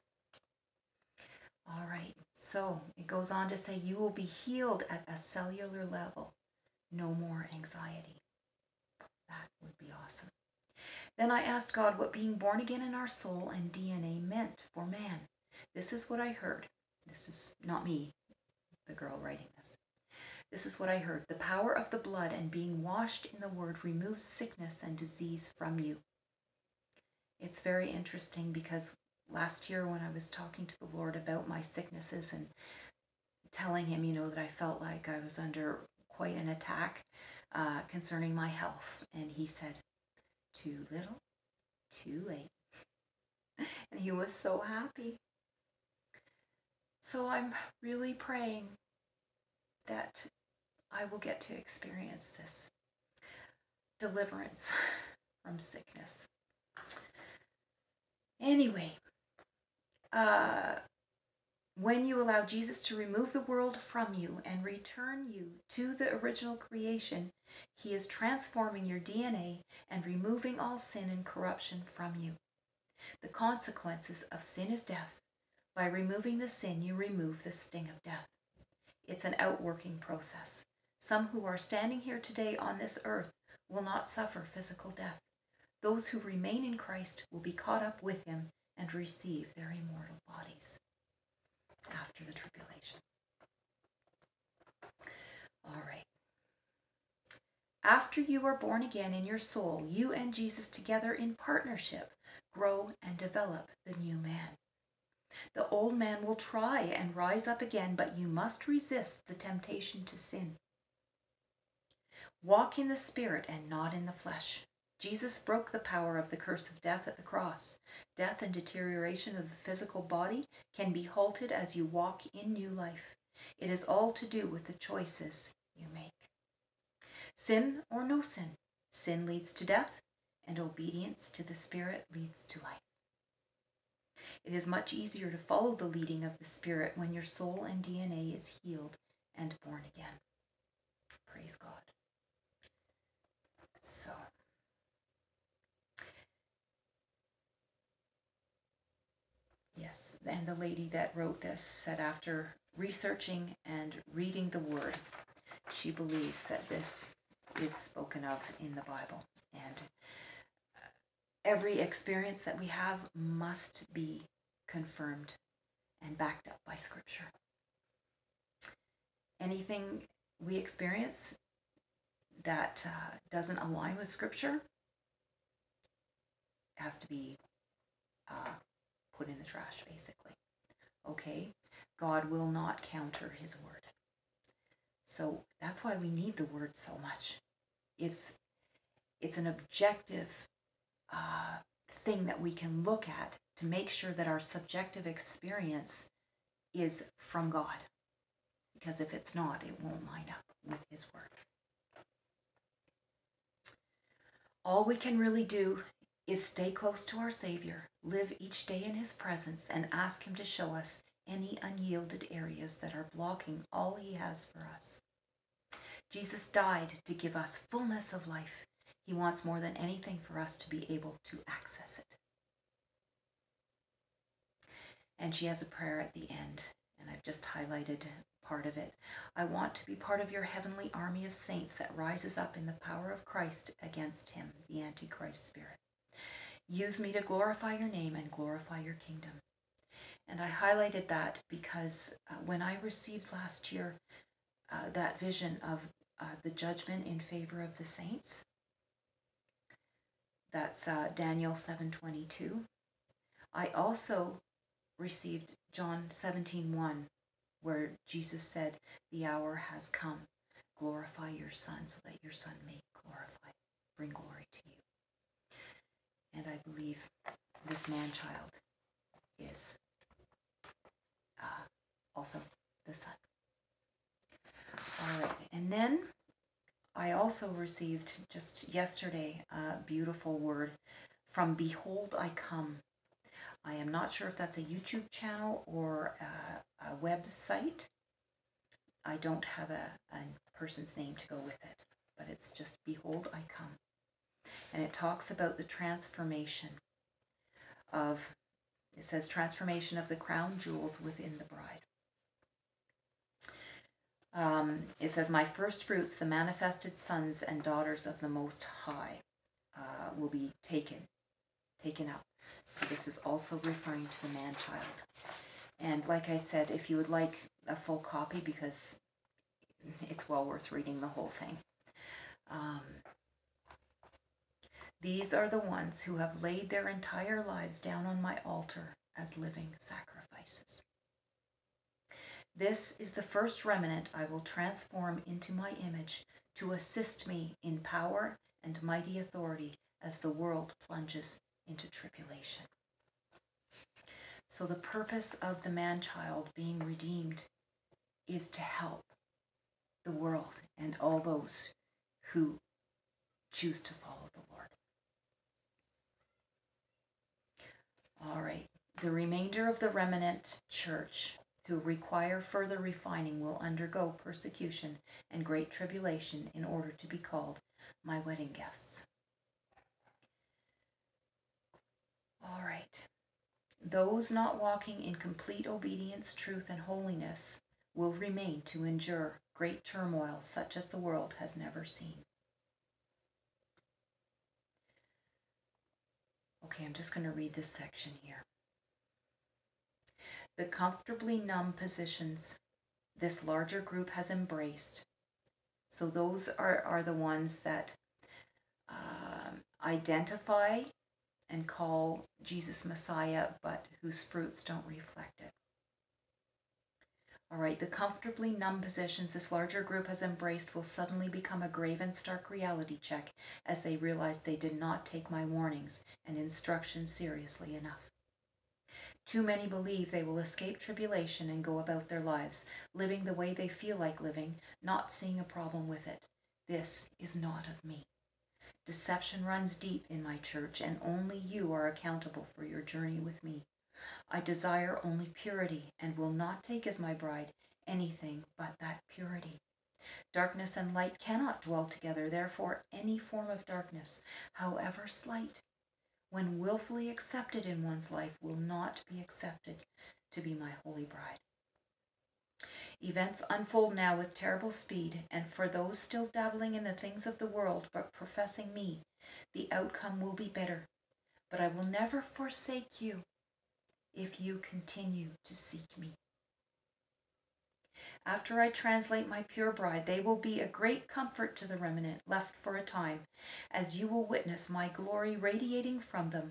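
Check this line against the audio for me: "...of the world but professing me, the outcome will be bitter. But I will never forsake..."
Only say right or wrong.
right.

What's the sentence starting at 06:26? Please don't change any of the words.
Okay, I'm just going to read this section here the comfortably numb positions this larger group has embraced.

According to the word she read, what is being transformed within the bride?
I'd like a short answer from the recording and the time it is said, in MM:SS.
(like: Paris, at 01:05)
the crown jewels, at 05:00.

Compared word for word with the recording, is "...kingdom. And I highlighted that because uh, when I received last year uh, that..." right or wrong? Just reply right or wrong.
right.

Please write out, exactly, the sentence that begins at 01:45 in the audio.
The old man will try and rise up again, but you must resist the temptation to sin.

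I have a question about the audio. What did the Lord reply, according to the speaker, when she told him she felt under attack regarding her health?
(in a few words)
too little, too late.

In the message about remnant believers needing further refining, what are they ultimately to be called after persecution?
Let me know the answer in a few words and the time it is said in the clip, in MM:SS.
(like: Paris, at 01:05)
my wedding guests, at 06:08.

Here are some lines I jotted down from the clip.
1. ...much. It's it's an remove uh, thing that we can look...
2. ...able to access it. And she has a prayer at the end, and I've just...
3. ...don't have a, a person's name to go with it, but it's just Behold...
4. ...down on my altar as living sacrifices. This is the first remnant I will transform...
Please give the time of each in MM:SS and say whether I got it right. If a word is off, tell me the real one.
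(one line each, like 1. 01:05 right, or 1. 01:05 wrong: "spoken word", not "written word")
1. 03:07 wrong: "objective", not "remove"
2. 03:40 right
3. 04:49 right
4. 05:27 right.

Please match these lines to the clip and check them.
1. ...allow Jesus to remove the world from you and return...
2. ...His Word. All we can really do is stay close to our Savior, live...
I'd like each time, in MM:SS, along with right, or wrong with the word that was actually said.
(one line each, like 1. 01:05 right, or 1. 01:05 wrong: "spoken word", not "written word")
1. 01:02 right
2. 03:20 right.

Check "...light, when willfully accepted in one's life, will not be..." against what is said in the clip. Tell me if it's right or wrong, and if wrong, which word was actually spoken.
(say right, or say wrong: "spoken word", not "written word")
wrong: "slight", not "light".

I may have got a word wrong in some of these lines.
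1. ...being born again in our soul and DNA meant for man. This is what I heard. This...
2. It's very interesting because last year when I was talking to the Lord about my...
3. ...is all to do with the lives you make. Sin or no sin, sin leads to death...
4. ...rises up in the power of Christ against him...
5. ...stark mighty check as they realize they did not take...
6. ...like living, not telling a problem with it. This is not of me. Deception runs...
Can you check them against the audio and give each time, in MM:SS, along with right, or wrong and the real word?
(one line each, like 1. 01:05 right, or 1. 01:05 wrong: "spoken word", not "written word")
1. 00:12 right
2. 00:27 right
3. 02:03 wrong: "choices", not "lives"
4. 03:51 right
5. 06:52 wrong: "reality", not "mighty"
6. 07:03 wrong: "seeing", not "telling".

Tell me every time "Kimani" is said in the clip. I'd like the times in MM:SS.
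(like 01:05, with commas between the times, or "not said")
not said.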